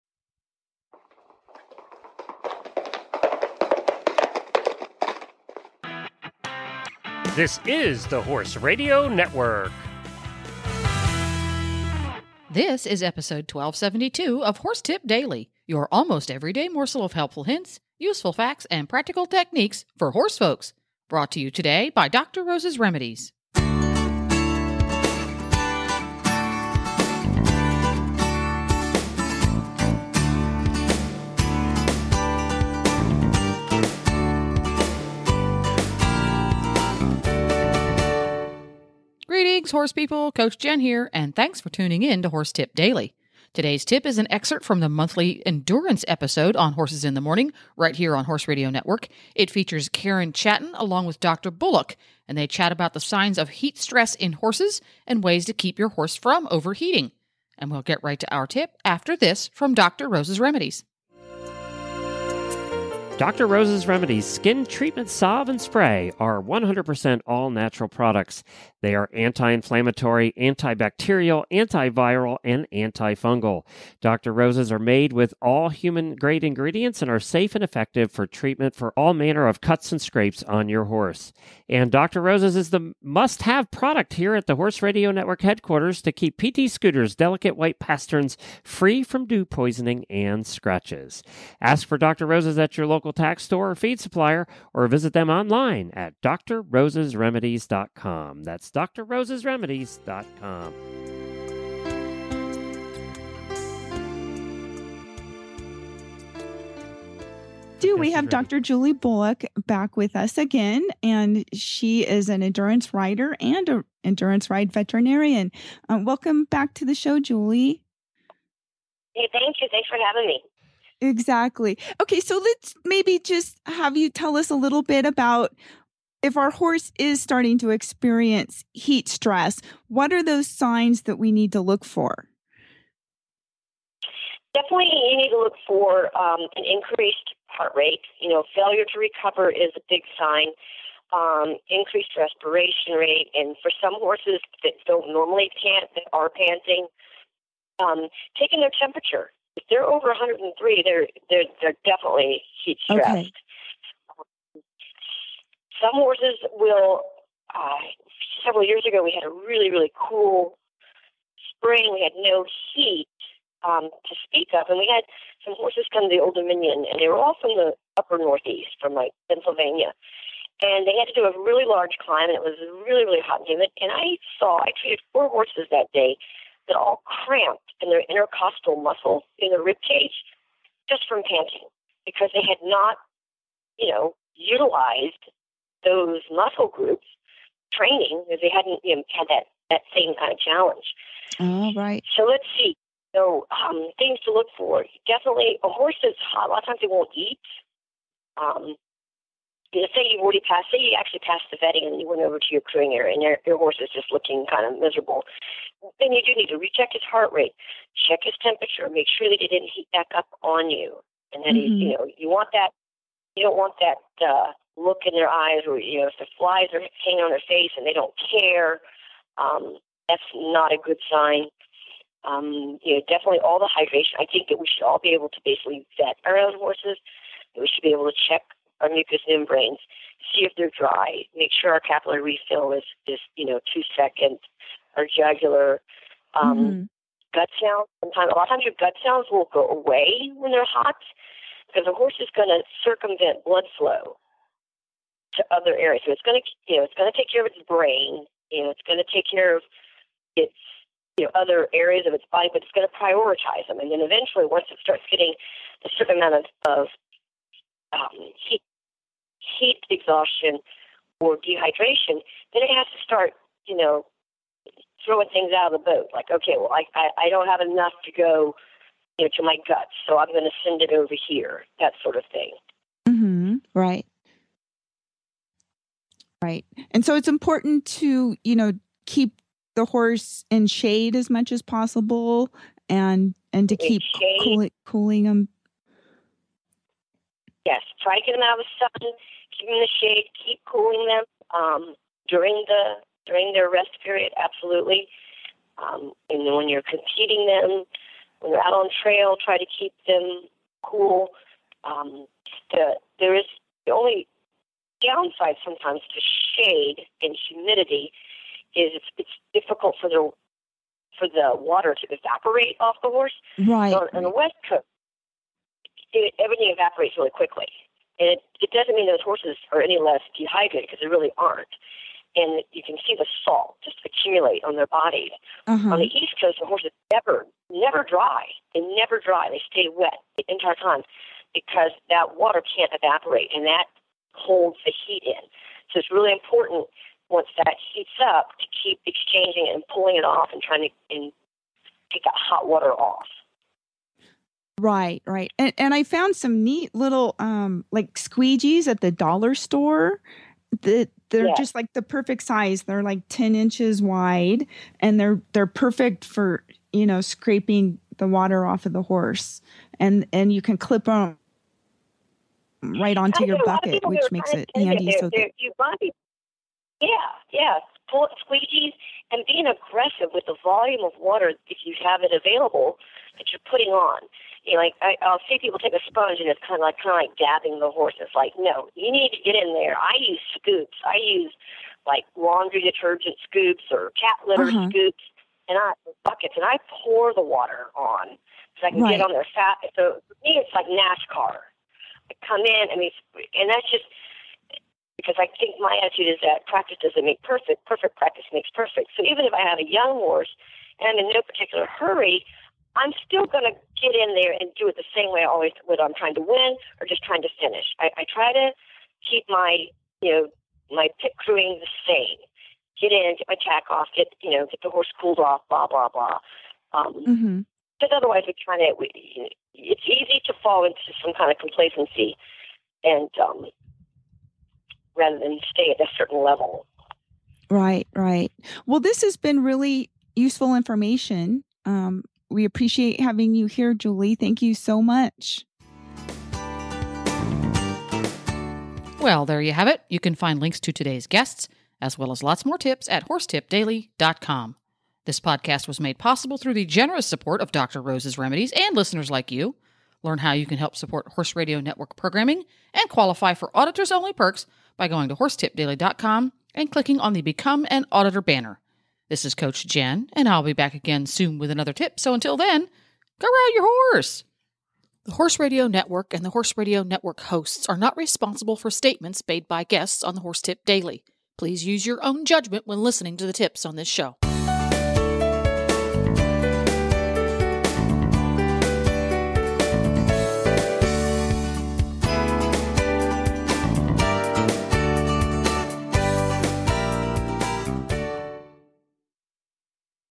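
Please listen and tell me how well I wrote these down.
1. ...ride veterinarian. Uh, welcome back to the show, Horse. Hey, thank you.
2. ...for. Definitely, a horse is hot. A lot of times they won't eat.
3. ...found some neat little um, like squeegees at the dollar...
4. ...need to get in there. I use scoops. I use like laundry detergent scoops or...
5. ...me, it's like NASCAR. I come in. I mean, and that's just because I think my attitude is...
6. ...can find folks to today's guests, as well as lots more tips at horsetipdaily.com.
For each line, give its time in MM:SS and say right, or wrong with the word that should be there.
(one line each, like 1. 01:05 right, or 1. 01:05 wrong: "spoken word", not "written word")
1. 01:54 wrong: "Julie", not "Horse"
2. 03:14 right
3. 05:46 right
4. 06:19 right
5. 06:30 right
6. 07:20 wrong: "links", not "folks".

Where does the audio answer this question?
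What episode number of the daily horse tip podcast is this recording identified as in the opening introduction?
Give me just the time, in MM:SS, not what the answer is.
00:13.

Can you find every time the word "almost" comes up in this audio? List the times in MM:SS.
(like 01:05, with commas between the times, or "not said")
00:15.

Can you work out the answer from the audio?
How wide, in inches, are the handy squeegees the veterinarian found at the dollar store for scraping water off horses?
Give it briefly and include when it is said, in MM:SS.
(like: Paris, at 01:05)
10 inches, at 05:53.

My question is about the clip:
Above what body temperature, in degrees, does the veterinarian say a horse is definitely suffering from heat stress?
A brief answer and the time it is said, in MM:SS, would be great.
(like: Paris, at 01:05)
103, at 02:30.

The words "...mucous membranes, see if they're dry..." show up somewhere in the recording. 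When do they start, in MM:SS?
03:48.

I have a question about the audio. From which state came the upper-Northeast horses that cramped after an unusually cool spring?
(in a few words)
Pennsylvania.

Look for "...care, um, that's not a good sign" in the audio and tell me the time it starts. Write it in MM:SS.
03:38.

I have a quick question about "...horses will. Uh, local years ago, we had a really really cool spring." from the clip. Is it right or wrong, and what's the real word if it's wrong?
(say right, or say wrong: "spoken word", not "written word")
wrong: "several", not "local".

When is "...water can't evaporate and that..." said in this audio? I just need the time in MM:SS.
05:32.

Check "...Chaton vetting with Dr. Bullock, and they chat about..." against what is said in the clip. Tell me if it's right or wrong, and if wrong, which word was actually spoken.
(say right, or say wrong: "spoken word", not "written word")
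wrong: "along", not "vetting".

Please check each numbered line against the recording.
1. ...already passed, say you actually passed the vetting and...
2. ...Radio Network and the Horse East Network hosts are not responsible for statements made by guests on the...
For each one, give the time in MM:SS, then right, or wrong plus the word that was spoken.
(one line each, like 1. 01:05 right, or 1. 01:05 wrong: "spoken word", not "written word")
1. 03:20 right
2. 07:45 wrong: "Radio", not "East".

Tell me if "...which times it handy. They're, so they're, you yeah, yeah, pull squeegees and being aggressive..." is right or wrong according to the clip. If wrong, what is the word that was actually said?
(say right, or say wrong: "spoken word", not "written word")
wrong: "makes", not "times".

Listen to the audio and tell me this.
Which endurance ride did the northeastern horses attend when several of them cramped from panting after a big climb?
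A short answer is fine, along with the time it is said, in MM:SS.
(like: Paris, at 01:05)
Old Dominion, at 02:46.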